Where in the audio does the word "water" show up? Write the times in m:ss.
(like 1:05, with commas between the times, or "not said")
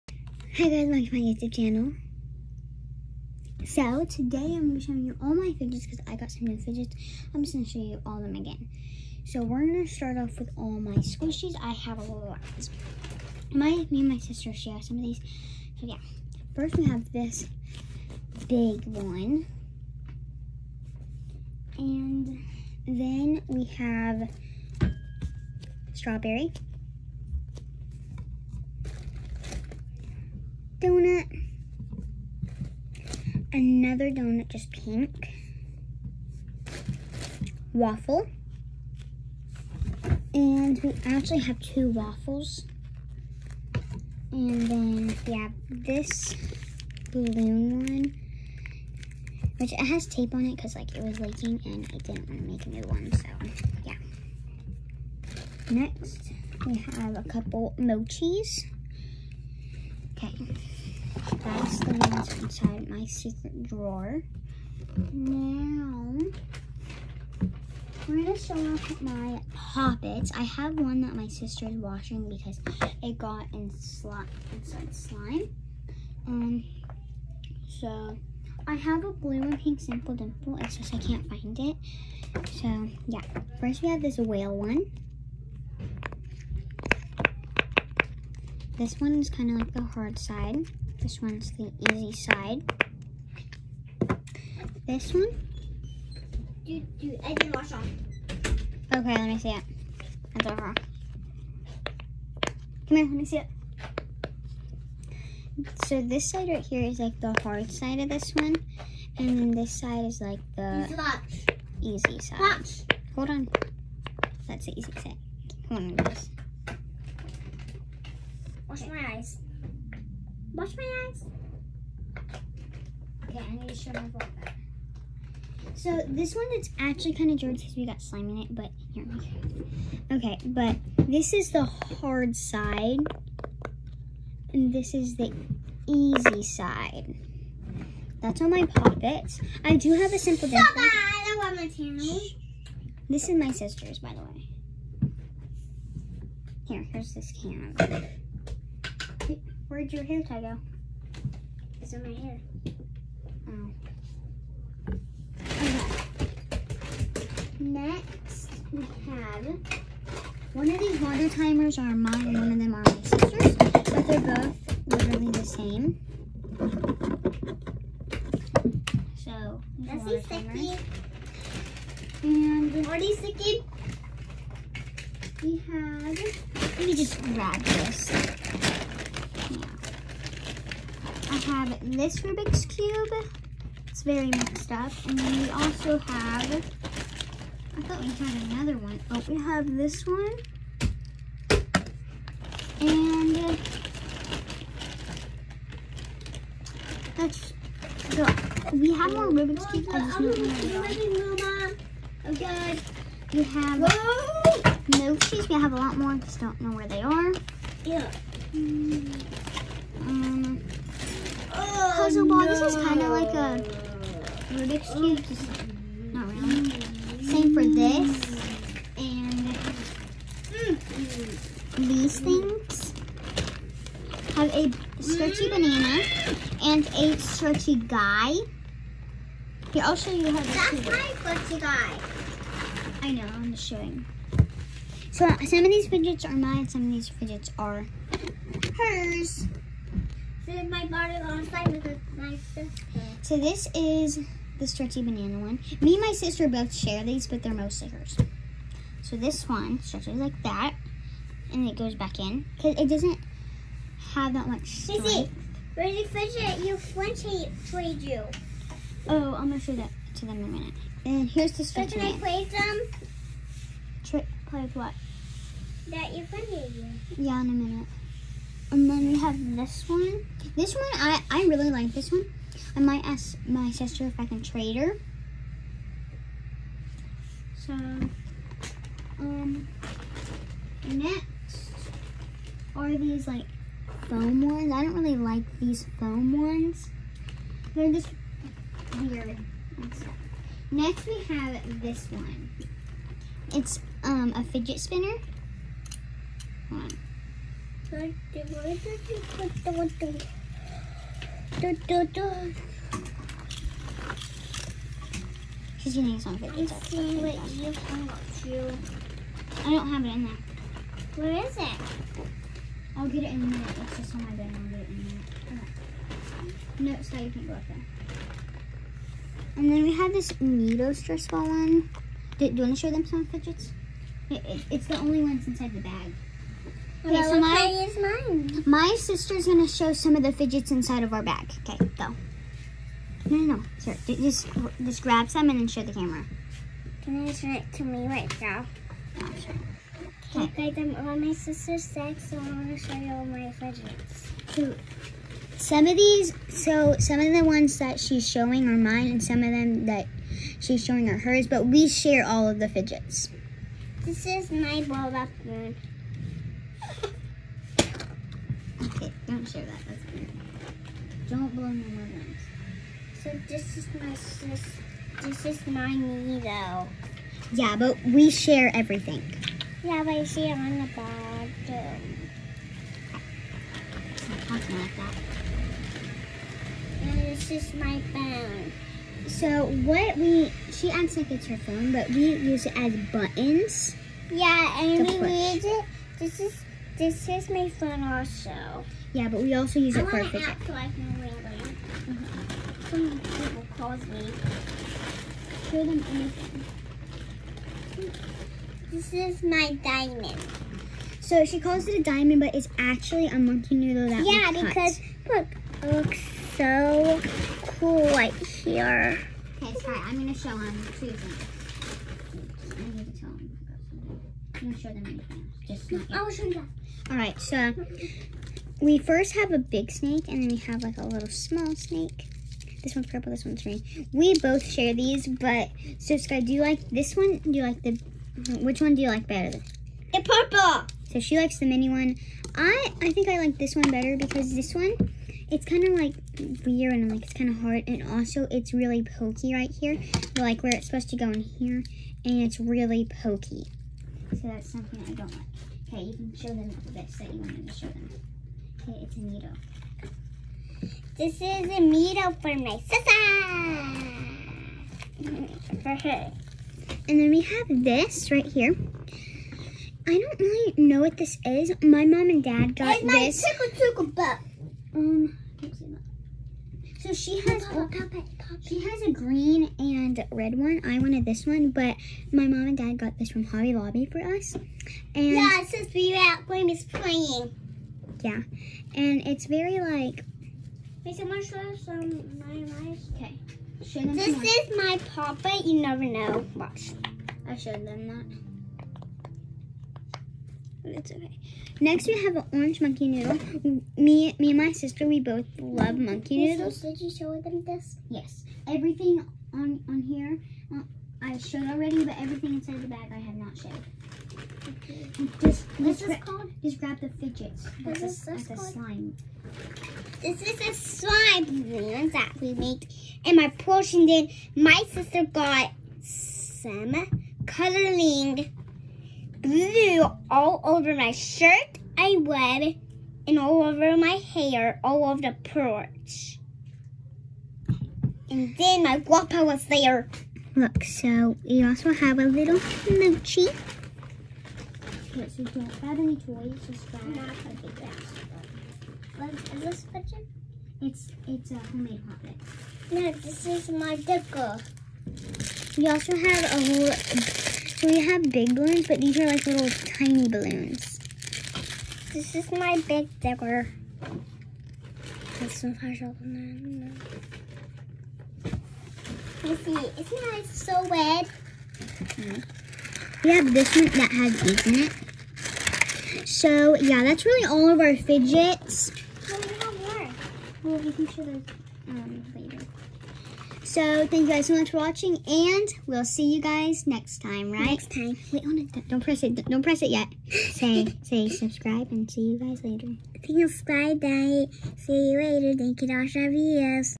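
2:40, 2:50.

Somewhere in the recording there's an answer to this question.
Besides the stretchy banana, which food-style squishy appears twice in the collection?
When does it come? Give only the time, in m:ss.
0:41.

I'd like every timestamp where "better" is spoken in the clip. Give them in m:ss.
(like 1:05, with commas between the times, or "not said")
7:09, 7:13.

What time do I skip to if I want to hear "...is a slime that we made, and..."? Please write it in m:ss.
8:30.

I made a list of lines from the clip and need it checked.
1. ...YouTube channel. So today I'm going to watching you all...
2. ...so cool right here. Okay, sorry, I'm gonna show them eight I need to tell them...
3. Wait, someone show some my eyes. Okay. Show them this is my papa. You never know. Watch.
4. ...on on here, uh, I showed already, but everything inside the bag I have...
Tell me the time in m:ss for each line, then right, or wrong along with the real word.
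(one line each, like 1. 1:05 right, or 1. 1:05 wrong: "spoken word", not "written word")
1. 0:01 wrong: "showing", not "watching"
2. 6:46 wrong: "two", not "eight"
3. 8:01 right
4. 8:19 right.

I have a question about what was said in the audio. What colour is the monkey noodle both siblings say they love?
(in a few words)
orange.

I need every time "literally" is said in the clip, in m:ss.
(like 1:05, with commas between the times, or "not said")
2:44.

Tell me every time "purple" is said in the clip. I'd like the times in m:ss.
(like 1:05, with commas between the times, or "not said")
7:03, 7:10.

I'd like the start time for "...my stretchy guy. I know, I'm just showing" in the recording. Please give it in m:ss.
3:50.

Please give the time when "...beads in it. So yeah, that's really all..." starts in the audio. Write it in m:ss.
9:24.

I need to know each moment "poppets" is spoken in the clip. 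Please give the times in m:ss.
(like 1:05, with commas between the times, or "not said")
1:09, 2:18.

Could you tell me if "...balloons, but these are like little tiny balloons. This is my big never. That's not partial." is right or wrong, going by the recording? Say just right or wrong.
wrong.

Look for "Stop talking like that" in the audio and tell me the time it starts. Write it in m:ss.
6:14.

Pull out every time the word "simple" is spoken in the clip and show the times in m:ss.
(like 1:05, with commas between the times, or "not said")
1:19, 2:20.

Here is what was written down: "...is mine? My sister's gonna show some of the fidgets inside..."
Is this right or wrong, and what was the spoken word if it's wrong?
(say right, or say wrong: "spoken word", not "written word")
right.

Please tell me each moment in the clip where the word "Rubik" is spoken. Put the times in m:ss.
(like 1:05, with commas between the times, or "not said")
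3:02, 3:19, 3:34.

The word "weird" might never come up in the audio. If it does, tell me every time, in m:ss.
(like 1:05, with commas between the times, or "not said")
4:49, 6:00, 7:16.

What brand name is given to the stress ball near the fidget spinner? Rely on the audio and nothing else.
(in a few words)
Neato.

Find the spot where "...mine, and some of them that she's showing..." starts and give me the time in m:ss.
5:48.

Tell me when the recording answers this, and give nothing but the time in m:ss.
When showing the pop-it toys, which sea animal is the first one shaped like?
1:24.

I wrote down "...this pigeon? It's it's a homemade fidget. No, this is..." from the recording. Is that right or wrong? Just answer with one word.
wrong.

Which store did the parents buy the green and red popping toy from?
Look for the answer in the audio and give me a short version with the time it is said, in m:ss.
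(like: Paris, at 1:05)
Hobby Lobby, at 7:53.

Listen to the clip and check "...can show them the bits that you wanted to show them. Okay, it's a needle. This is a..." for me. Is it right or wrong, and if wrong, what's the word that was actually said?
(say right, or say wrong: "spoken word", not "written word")
right.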